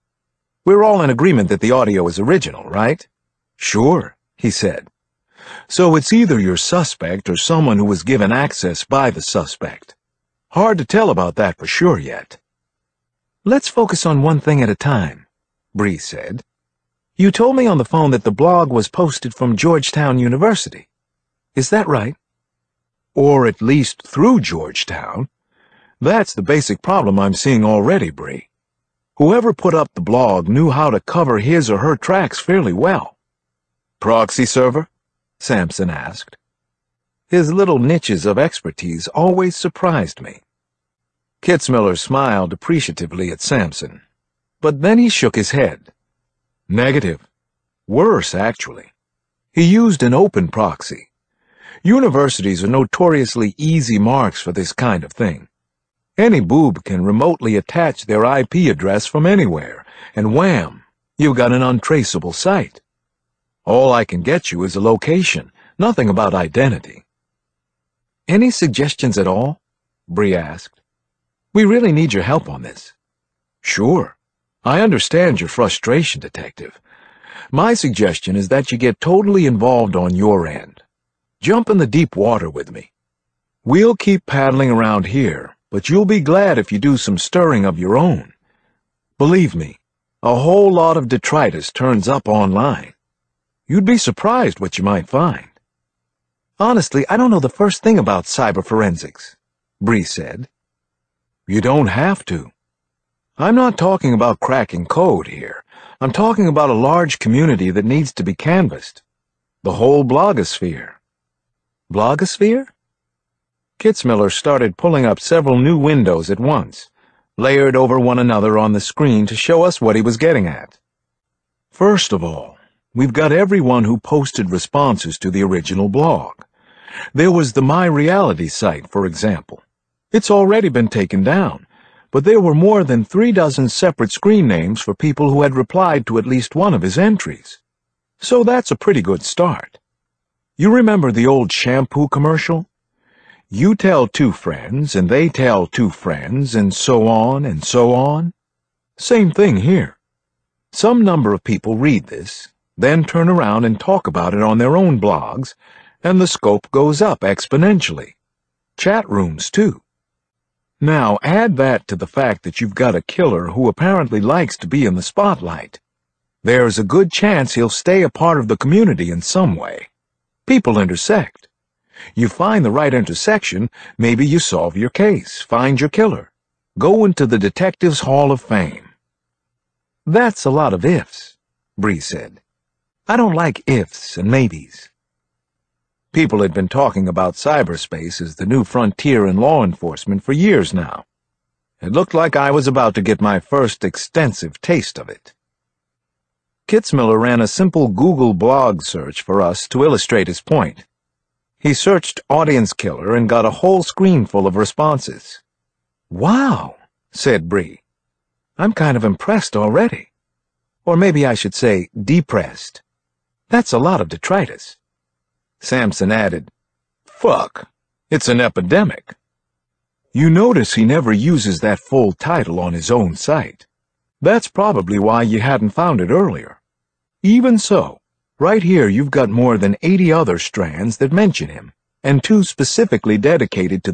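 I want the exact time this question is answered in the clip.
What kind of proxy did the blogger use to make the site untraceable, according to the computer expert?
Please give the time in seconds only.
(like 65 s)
50 s.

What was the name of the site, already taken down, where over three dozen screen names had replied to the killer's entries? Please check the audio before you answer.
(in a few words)
My Reality.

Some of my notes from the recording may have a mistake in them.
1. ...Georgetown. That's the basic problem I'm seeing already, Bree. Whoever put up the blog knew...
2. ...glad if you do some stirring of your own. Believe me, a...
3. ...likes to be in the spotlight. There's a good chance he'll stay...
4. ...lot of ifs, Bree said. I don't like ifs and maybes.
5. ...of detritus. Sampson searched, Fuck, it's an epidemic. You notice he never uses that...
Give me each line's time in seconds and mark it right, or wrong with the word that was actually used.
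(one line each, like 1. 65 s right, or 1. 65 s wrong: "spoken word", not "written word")
1. 24 s right
2. 86 s right
3. 164 s right
4. 180 s right
5. 214 s wrong: "added", not "searched".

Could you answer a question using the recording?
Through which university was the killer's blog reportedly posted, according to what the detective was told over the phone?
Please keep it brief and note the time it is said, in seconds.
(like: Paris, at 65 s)
Georgetown University, at 19 s.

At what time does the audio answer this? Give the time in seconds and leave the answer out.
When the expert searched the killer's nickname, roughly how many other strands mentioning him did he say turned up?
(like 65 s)
229 s.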